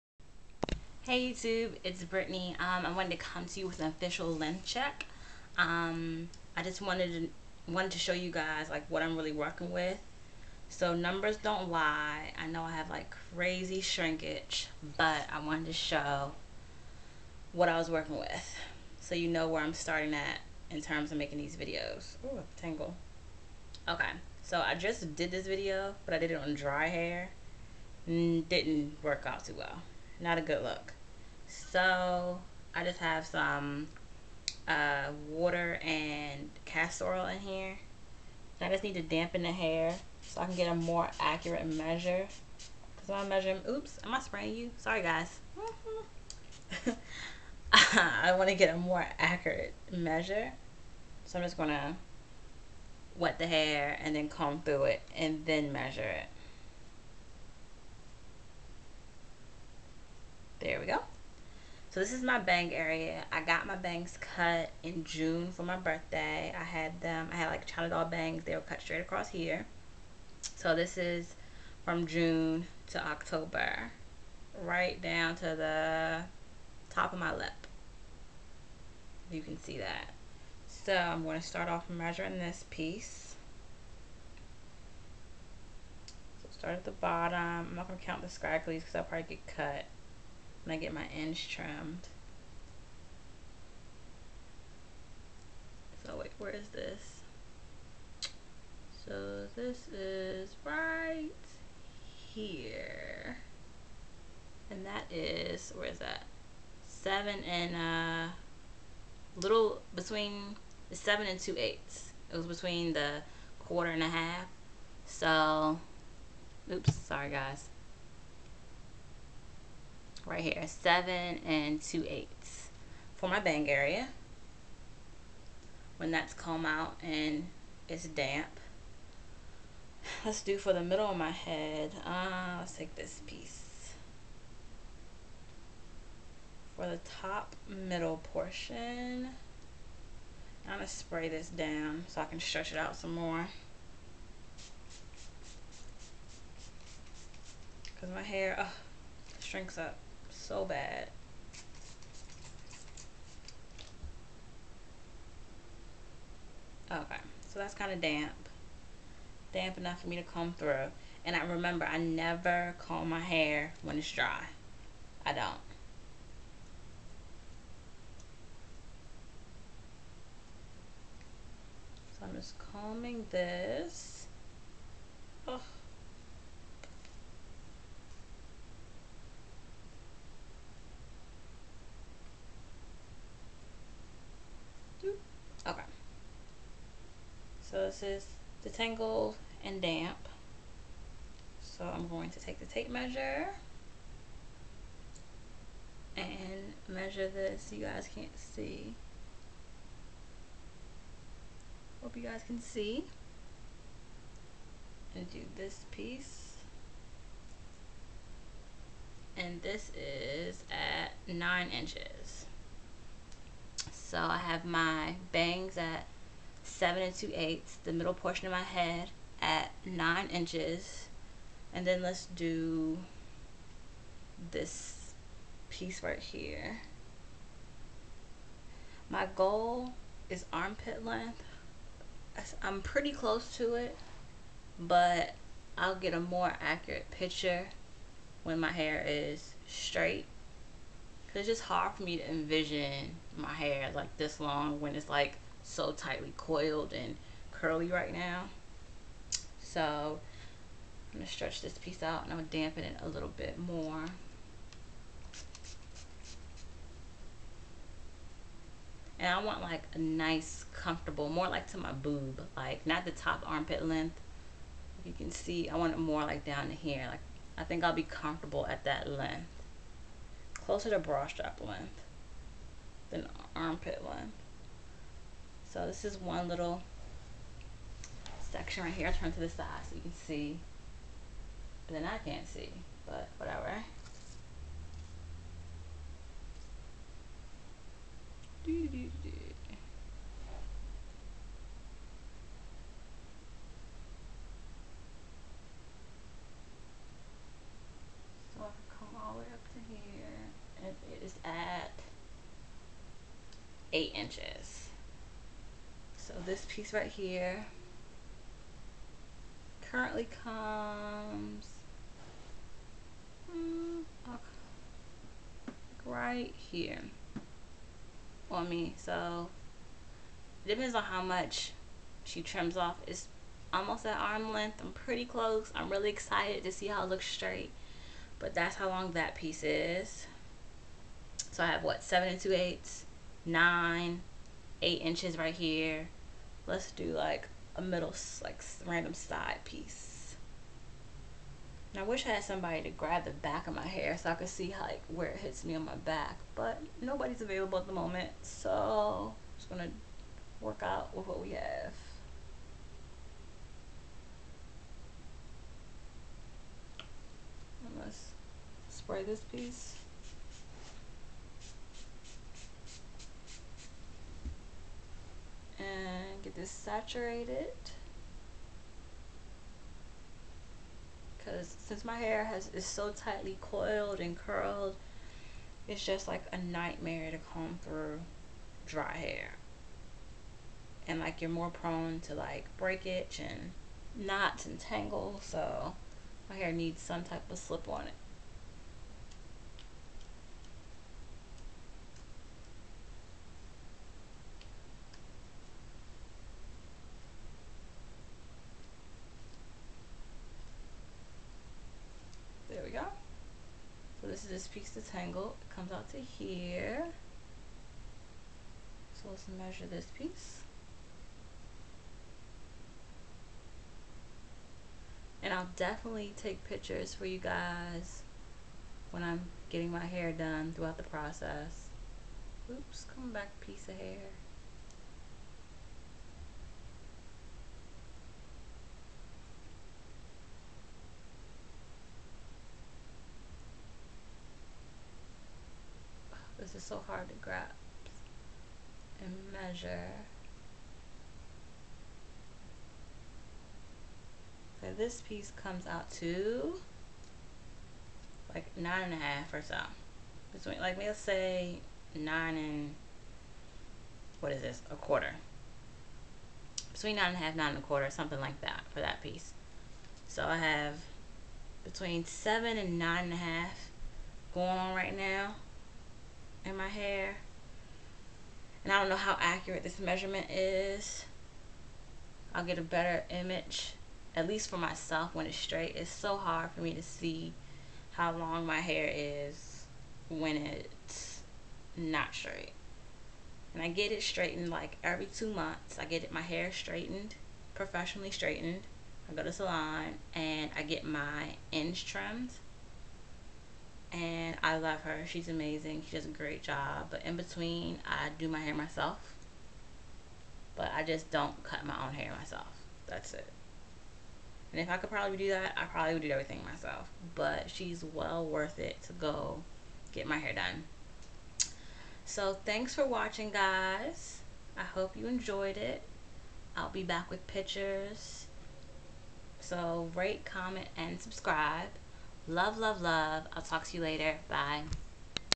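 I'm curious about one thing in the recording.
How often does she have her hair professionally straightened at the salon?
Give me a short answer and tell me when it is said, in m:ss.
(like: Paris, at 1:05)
every two months, at 8:05.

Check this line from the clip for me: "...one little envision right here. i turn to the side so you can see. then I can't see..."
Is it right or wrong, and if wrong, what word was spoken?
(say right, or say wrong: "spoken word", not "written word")
wrong: "section", not "envision".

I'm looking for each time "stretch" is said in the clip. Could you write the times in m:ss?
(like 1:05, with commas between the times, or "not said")
2:22, 4:11.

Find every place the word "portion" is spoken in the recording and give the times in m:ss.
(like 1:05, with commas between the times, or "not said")
2:18, 3:38.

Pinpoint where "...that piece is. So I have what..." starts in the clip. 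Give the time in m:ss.
5:29.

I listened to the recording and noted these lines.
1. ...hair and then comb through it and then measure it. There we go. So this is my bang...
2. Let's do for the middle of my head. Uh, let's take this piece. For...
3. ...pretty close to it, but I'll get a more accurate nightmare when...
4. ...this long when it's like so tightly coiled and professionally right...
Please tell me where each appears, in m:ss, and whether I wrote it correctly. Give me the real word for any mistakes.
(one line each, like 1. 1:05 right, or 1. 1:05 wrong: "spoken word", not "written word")
1. 0:53 right
2. 2:10 right
3. 3:52 wrong: "picture", not "nightmare"
4. 4:04 wrong: "curly", not "professionally".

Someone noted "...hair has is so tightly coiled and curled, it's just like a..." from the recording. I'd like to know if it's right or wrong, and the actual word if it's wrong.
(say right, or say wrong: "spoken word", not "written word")
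right.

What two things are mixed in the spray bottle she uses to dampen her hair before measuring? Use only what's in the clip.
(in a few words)
water and castor oil.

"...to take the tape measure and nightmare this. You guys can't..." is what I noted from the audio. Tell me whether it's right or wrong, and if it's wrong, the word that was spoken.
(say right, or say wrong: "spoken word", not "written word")
wrong: "measure", not "nightmare".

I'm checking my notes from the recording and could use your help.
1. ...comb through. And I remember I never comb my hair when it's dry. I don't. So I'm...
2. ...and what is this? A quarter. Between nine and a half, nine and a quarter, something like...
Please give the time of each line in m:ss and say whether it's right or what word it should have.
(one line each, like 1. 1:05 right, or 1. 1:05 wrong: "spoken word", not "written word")
1. 2:40 right
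2. 7:32 right.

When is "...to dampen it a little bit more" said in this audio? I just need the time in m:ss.
4:12.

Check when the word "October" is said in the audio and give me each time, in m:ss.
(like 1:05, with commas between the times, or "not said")
1:13.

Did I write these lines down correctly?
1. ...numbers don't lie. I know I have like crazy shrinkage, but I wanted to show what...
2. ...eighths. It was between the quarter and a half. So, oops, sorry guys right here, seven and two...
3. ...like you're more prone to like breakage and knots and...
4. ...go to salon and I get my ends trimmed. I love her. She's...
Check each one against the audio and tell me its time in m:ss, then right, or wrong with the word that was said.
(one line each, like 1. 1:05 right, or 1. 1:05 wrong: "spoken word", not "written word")
1. 0:10 right
2. 1:51 right
3. 6:21 right
4. 8:09 right.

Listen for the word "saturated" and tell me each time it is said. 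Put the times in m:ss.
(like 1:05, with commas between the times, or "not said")
6:06.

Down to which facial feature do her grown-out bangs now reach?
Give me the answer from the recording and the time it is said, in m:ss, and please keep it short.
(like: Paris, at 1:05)
top of my lip, at 1:16.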